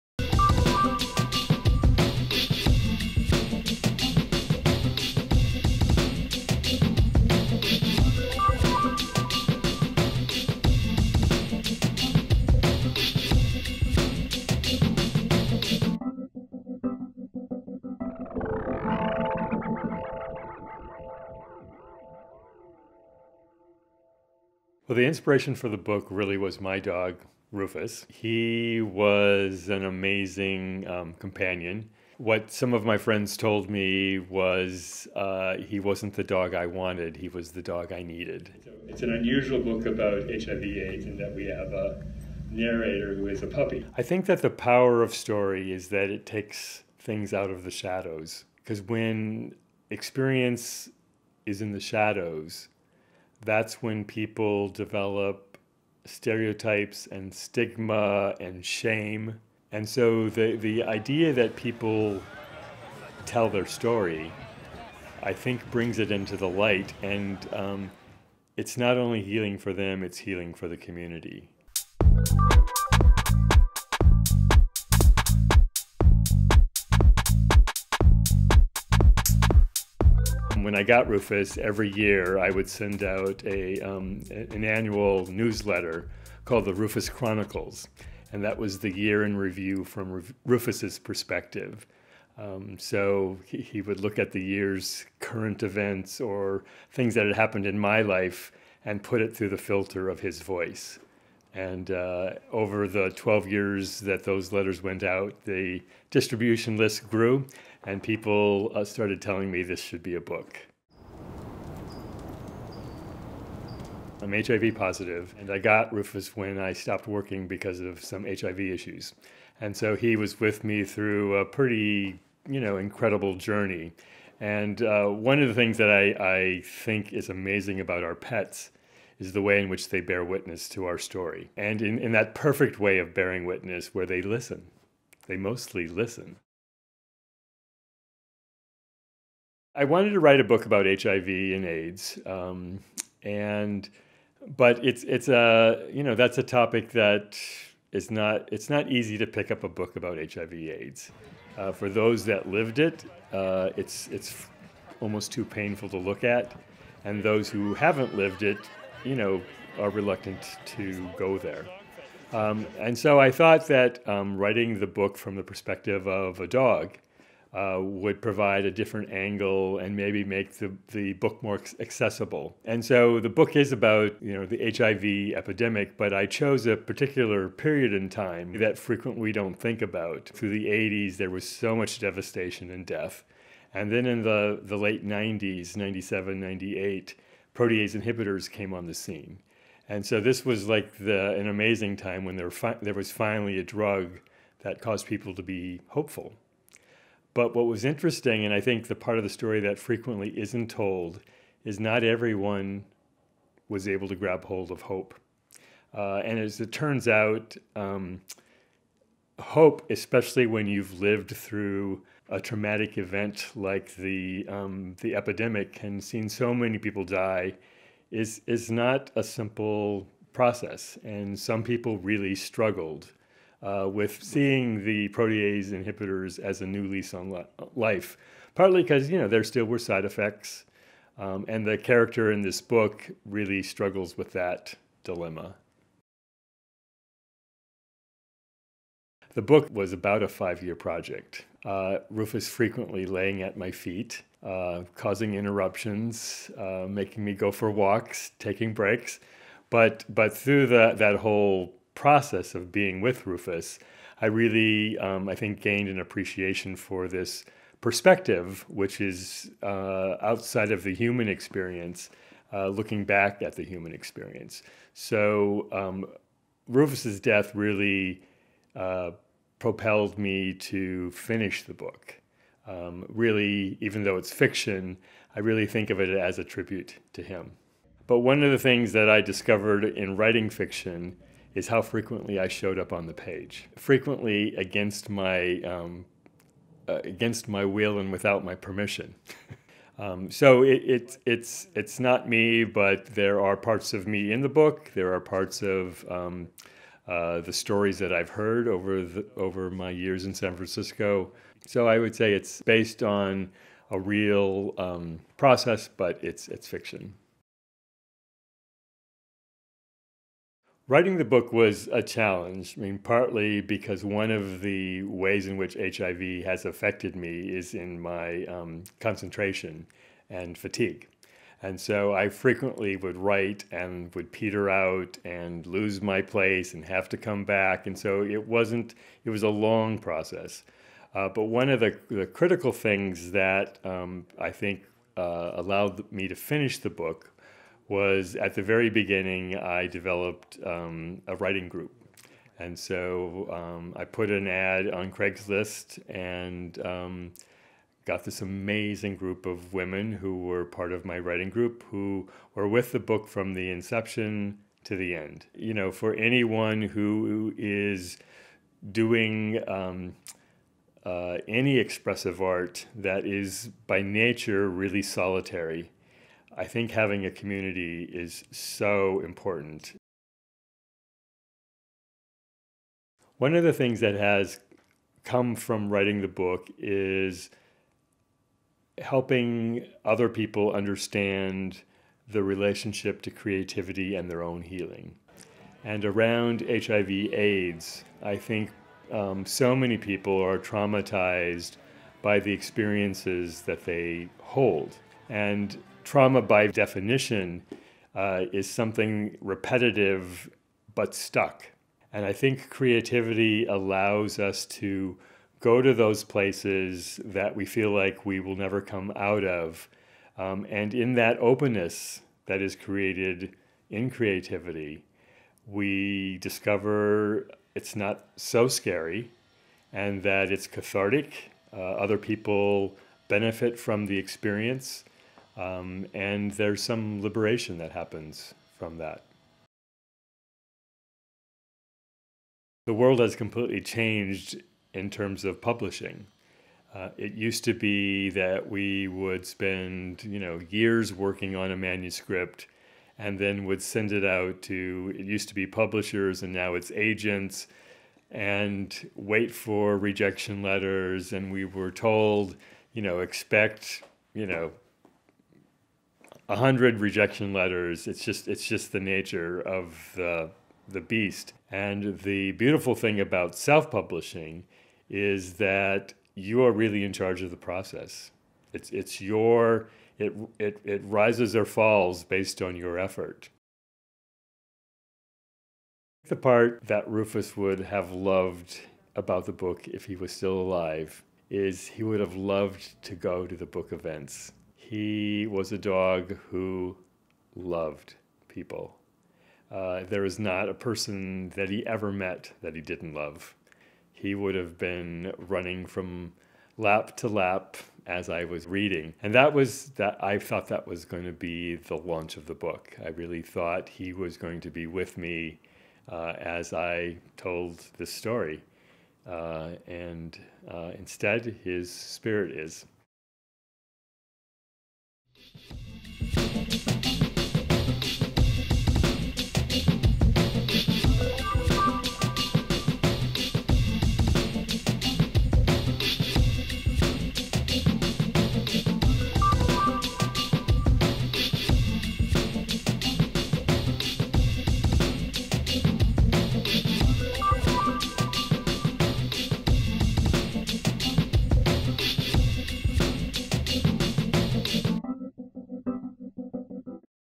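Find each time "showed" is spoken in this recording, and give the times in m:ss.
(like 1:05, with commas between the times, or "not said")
4:42.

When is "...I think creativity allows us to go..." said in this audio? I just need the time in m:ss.
6:42.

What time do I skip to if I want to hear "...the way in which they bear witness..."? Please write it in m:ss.
2:09.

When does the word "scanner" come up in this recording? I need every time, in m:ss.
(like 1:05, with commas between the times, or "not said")
not said.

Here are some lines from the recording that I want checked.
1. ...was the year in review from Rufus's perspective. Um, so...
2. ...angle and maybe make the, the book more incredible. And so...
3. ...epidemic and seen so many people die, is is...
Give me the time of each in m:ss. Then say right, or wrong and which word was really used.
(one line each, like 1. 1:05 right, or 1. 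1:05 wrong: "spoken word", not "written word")
1. 1:28 right
2. 2:49 wrong: "accessible", not "incredible"
3. 3:35 right.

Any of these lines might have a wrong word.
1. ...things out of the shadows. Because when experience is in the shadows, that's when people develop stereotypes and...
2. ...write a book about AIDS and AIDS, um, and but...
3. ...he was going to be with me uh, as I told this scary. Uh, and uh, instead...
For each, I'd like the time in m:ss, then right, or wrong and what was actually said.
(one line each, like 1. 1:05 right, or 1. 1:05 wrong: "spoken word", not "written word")
1. 0:46 right
2. 2:20 wrong: "HIV", not "AIDS"
3. 8:23 wrong: "story", not "scary".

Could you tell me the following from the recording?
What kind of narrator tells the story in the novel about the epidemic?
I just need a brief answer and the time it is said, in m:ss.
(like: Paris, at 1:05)
A puppy, at 0:43.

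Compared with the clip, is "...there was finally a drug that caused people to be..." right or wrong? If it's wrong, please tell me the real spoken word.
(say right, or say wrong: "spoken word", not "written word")
right.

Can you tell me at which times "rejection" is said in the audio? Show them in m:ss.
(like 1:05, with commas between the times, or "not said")
7:29, 7:36.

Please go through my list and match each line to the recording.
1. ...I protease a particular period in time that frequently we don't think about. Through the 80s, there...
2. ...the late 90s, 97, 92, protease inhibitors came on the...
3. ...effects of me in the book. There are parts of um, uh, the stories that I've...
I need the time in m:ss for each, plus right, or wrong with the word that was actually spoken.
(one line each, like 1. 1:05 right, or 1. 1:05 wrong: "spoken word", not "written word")
1. 2:56 wrong: "chose", not "protease"
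2. 3:04 wrong: "98", not "92"
3. 4:53 wrong: "parts", not "effects".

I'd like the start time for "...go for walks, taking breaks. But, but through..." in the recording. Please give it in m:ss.
4:07.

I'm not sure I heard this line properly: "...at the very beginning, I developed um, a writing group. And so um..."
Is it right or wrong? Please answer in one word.
right.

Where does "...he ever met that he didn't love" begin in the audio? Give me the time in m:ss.
8:11.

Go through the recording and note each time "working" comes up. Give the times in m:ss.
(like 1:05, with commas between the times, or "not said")
1:57, 7:21.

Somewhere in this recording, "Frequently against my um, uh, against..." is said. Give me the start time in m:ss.
4:43.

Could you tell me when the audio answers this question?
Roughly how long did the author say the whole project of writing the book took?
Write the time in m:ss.
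4:00.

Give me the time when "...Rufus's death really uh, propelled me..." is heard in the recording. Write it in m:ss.
4:26.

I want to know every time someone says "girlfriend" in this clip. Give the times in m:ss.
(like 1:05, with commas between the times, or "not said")
not said.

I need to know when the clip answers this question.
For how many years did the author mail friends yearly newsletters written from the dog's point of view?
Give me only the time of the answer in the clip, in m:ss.
1:43.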